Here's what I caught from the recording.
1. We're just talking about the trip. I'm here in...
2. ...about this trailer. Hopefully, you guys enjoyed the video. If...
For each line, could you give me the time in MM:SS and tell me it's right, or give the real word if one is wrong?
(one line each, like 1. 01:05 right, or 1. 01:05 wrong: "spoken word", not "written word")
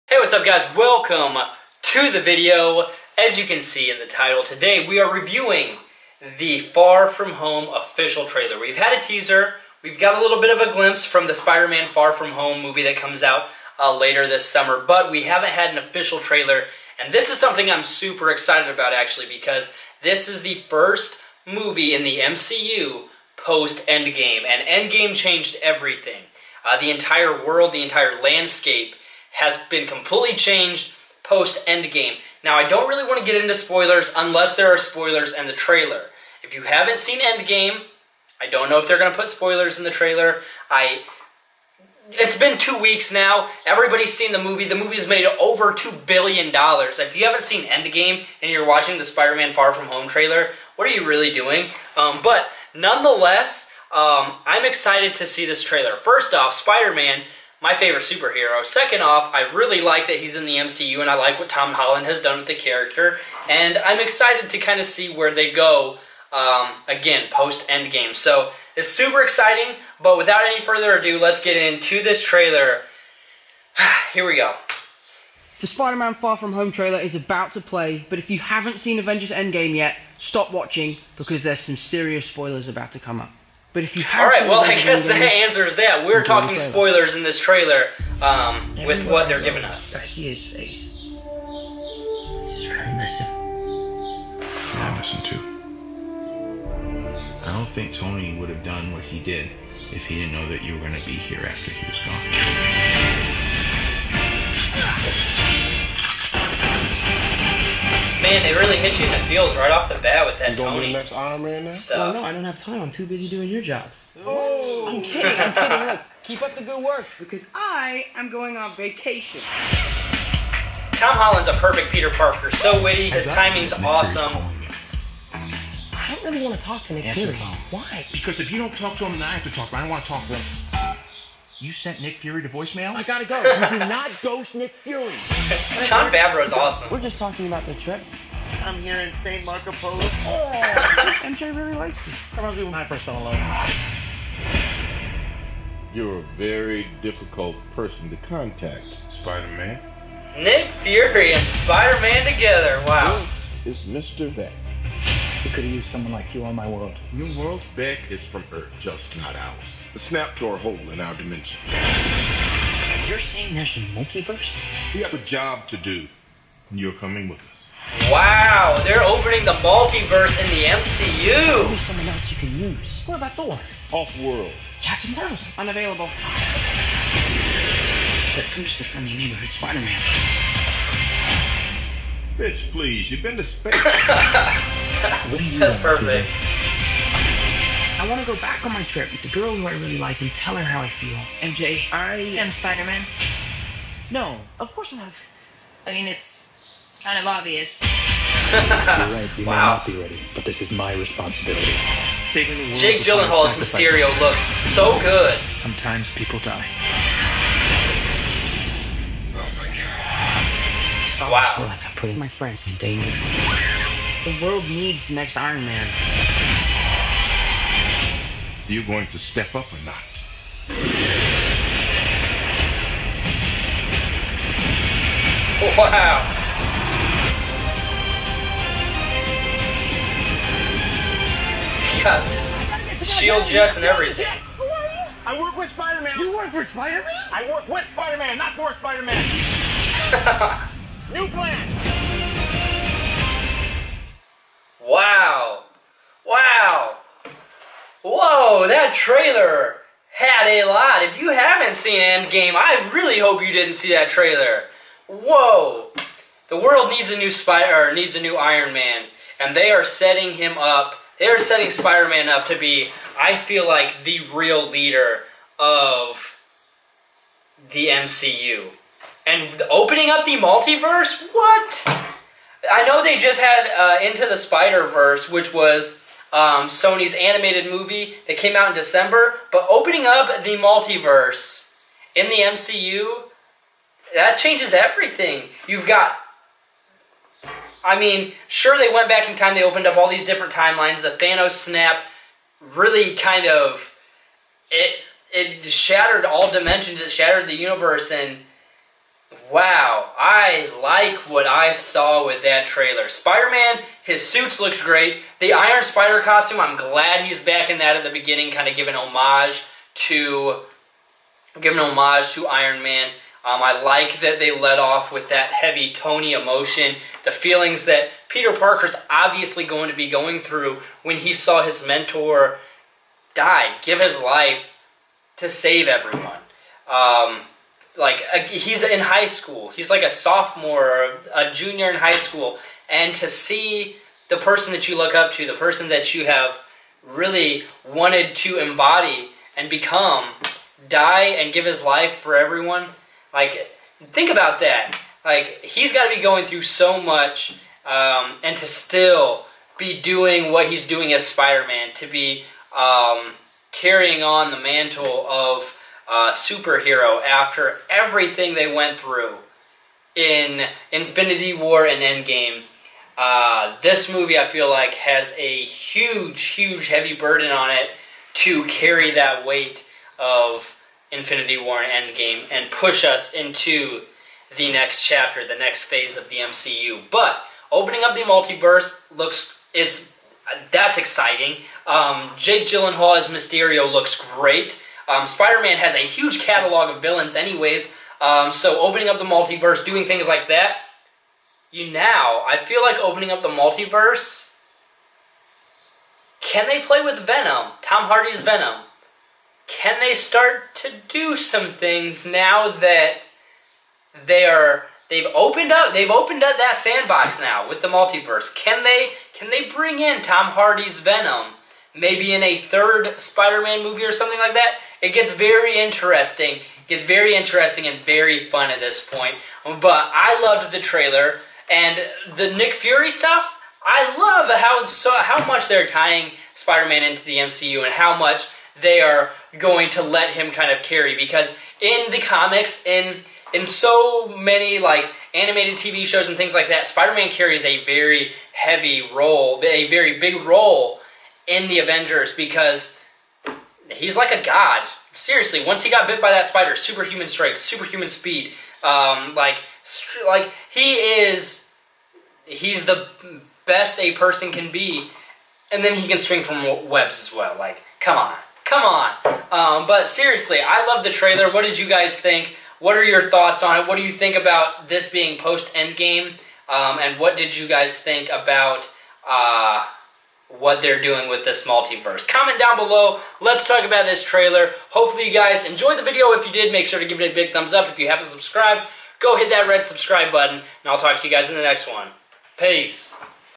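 1. 02:16 right
2. 07:53 right.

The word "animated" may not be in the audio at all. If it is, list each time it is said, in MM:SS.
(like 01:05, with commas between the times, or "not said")
04:37, 07:15.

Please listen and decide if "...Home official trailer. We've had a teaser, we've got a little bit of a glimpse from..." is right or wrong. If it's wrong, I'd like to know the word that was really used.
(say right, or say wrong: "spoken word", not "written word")
right.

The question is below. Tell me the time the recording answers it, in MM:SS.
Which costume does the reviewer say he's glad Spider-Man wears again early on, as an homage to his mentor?
05:05.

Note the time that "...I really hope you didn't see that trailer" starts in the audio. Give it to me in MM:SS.
04:12.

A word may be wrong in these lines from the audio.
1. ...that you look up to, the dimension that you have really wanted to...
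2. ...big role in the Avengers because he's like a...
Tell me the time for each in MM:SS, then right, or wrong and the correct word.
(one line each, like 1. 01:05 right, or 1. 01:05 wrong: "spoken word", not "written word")
1. 05:34 wrong: "person", not "dimension"
2. 07:20 right.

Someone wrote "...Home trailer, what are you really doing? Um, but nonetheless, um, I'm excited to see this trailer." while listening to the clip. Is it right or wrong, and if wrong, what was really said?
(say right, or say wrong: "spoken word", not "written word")
right.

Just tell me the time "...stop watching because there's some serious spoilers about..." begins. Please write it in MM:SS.
01:20.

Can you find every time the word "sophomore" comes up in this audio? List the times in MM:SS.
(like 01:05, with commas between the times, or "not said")
05:30.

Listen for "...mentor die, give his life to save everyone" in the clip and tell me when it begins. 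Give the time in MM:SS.
05:21.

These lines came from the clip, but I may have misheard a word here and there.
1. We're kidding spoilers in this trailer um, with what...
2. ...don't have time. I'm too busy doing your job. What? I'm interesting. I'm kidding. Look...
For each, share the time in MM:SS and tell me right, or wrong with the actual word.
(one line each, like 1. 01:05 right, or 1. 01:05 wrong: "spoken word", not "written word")
1. 01:26 wrong: "talking", not "kidding"
2. 01:52 wrong: "kidding", not "interesting".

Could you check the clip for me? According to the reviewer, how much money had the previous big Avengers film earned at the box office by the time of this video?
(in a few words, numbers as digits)
Over $2 billion.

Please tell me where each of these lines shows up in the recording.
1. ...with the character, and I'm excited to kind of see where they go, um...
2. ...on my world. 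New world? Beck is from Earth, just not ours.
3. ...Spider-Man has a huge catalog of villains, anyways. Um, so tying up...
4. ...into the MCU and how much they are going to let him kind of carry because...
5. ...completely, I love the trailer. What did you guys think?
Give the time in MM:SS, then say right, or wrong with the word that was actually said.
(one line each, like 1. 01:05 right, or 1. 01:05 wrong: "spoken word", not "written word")
1. 01:02 right
2. 02:36 right
3. 06:25 wrong: "opening", not "tying"
4. 07:07 right
5. 07:40 wrong: "seriously", not "completely".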